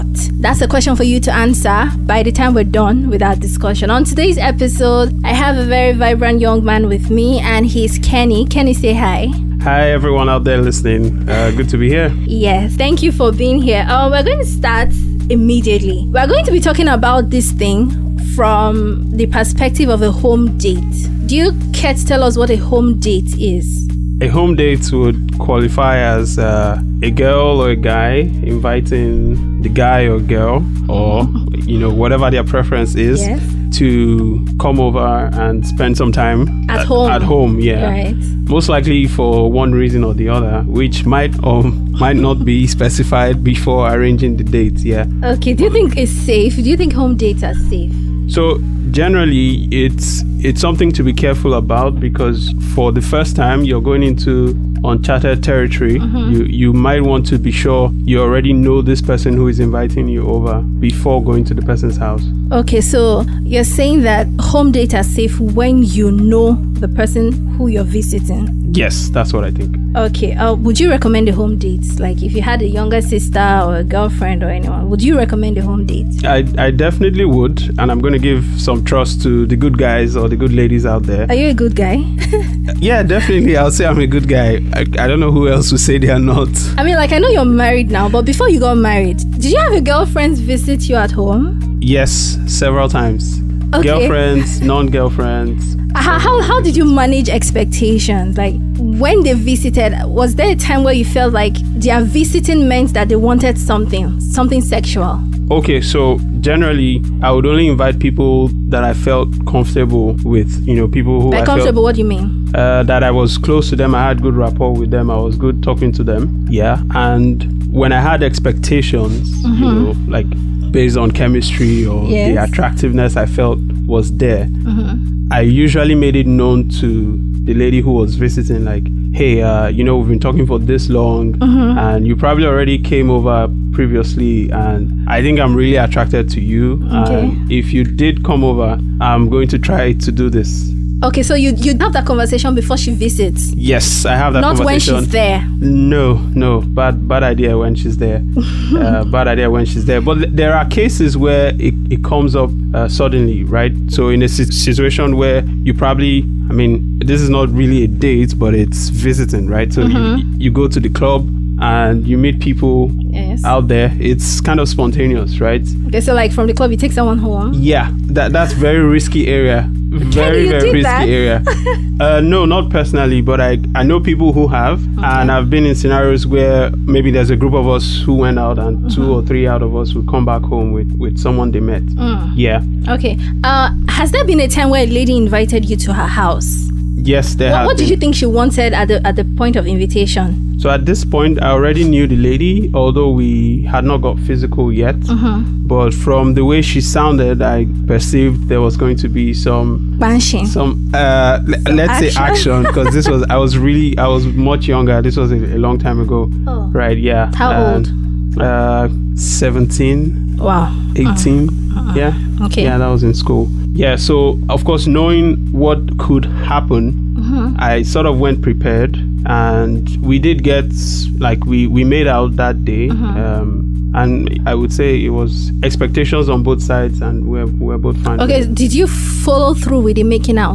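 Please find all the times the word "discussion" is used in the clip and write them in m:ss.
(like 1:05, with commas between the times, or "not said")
0:03.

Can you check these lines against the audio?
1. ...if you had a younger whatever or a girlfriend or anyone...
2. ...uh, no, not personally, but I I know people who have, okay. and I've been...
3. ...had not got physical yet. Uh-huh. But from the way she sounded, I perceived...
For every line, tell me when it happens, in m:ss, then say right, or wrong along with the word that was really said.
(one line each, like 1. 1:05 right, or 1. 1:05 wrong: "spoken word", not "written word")
1. 1:12 wrong: "sister", not "whatever"
2. 2:51 right
3. 3:13 right.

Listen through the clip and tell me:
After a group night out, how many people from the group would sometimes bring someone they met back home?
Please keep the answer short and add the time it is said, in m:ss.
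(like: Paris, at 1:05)
2 or 3, at 2:58.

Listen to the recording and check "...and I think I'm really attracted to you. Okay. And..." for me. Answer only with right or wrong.
right.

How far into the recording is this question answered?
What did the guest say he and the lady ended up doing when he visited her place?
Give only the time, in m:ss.
3:41.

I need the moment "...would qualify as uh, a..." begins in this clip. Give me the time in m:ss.
0:24.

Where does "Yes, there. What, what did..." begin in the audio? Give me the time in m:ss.
3:06.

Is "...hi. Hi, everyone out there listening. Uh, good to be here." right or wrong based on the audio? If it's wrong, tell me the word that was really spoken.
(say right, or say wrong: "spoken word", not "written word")
right.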